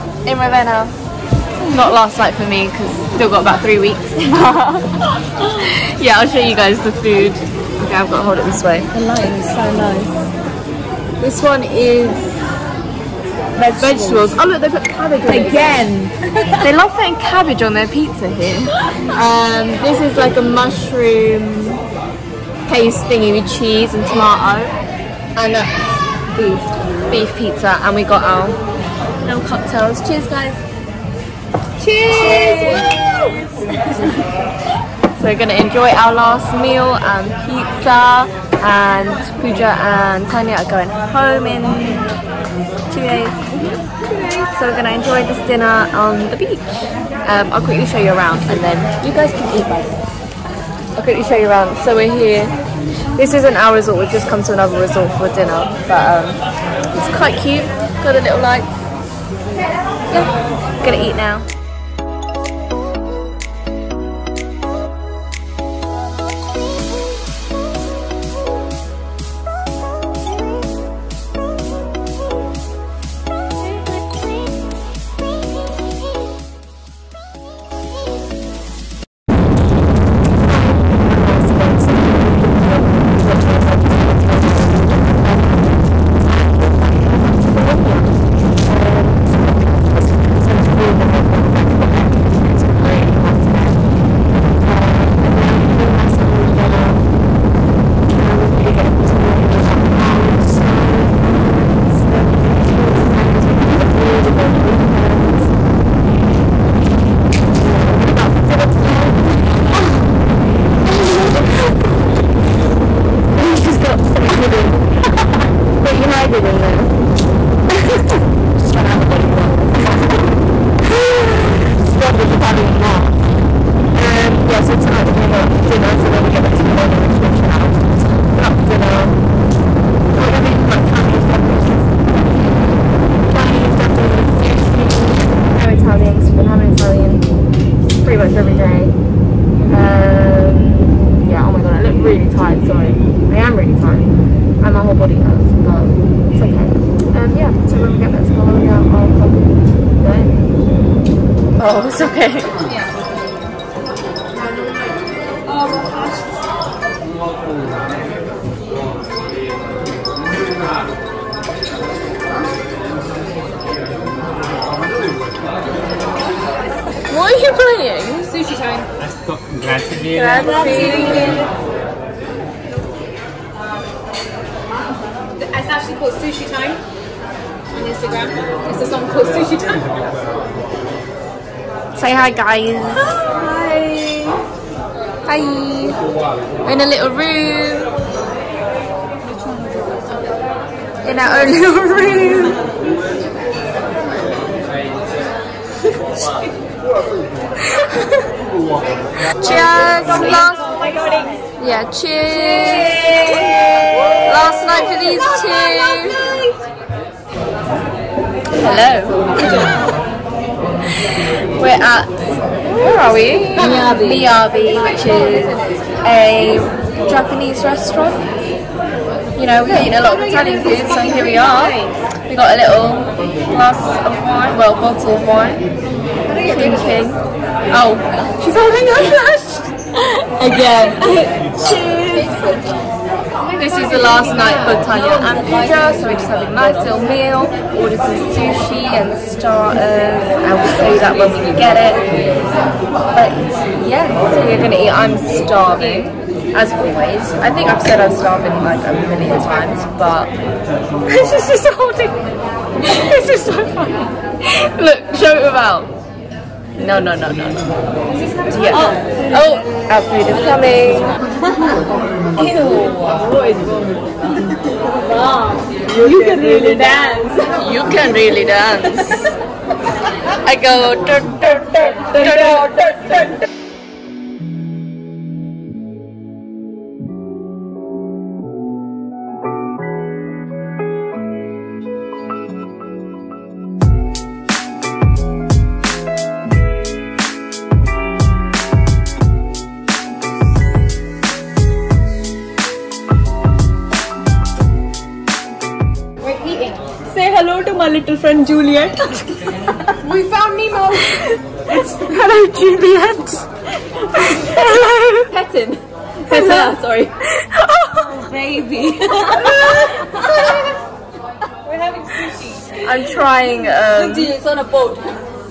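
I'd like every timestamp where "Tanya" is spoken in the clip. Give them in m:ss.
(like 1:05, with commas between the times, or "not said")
0:40, 3:54.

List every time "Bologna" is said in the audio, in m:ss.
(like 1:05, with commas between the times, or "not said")
2:06, 2:28.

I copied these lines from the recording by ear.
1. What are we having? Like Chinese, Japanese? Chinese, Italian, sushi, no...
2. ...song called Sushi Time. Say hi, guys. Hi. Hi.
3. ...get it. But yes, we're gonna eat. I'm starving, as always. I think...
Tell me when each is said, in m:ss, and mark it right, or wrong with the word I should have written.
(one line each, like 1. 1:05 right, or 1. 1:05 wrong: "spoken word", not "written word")
1. 2:10 wrong: "Japanese", not "Italian"
2. 2:58 right
3. 4:01 right.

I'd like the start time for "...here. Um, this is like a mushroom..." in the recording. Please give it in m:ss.
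0:18.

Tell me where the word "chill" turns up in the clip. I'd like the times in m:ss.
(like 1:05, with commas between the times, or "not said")
1:42, 2:07.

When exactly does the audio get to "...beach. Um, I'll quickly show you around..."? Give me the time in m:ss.
0:46.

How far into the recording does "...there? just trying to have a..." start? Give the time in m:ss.
1:56.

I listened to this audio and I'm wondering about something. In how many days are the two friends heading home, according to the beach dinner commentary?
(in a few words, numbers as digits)
2.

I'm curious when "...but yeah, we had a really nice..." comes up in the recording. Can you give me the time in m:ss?
1:35.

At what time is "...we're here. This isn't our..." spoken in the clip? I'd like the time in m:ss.
0:51.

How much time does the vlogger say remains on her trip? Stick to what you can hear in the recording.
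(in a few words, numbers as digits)
3 weeks.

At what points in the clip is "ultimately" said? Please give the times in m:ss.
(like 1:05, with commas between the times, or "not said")
not said.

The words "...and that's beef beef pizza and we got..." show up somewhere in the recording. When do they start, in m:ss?
0:25.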